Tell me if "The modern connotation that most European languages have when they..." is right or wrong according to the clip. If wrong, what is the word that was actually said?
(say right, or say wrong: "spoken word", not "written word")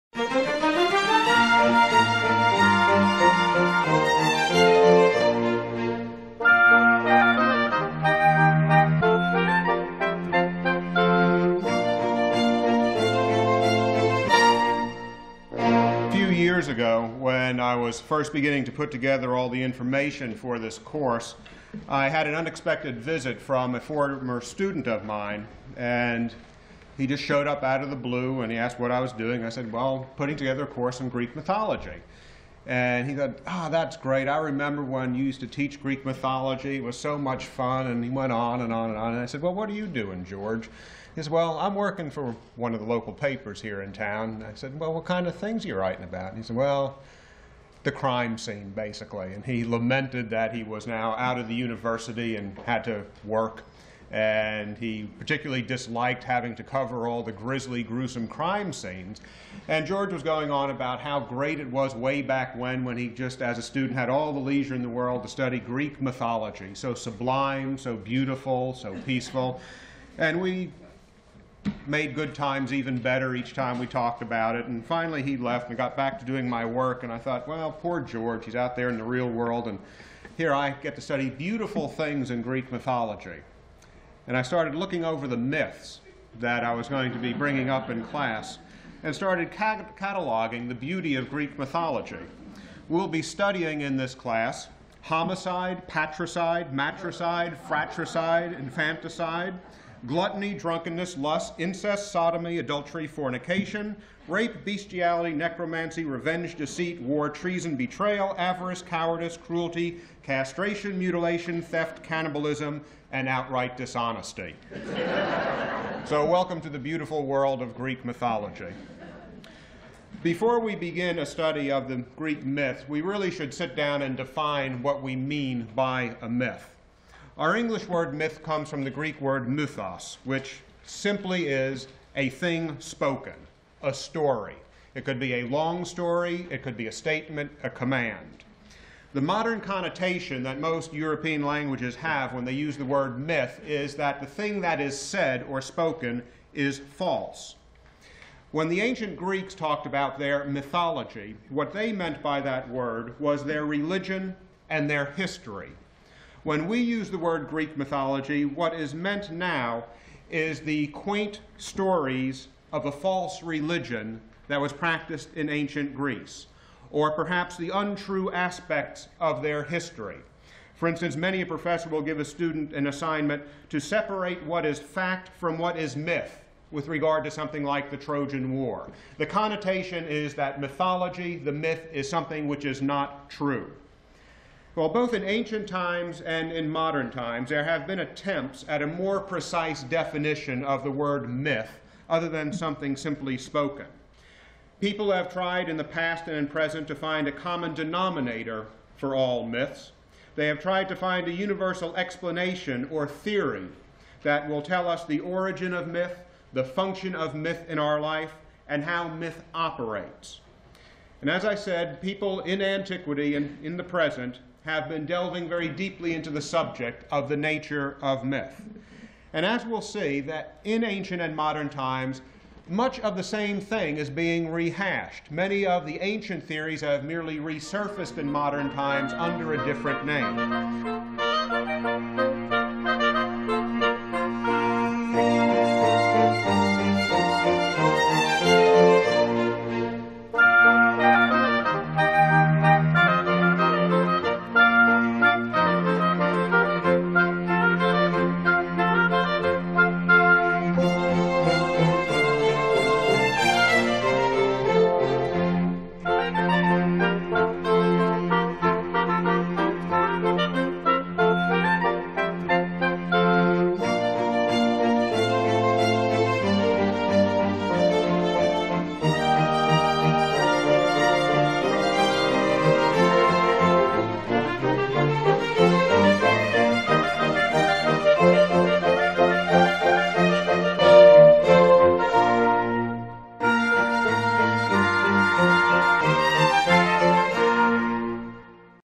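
right.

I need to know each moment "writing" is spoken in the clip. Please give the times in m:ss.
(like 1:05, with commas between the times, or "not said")
0:45.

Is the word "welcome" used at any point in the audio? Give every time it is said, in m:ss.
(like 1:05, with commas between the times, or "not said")
1:56.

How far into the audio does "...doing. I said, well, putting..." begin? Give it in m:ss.
0:29.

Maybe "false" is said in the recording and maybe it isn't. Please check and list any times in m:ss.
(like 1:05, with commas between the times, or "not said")
2:26, 2:42.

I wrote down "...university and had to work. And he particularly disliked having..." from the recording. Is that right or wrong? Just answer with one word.
right.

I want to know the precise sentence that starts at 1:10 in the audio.
And we made good times even better each time we talked about it.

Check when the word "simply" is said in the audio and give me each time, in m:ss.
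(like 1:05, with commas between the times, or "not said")
2:10, 3:12.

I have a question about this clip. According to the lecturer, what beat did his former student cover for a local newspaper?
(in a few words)
The crime scene.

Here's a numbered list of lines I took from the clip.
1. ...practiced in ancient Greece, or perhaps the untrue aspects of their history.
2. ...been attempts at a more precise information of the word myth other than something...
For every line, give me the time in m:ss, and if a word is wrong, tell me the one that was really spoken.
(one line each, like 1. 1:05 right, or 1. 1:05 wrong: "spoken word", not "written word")
1. 2:44 right
2. 3:07 wrong: "definition", not "information".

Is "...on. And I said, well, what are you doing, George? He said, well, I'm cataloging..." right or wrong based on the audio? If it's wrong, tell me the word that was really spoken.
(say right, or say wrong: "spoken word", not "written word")
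wrong: "working", not "cataloging".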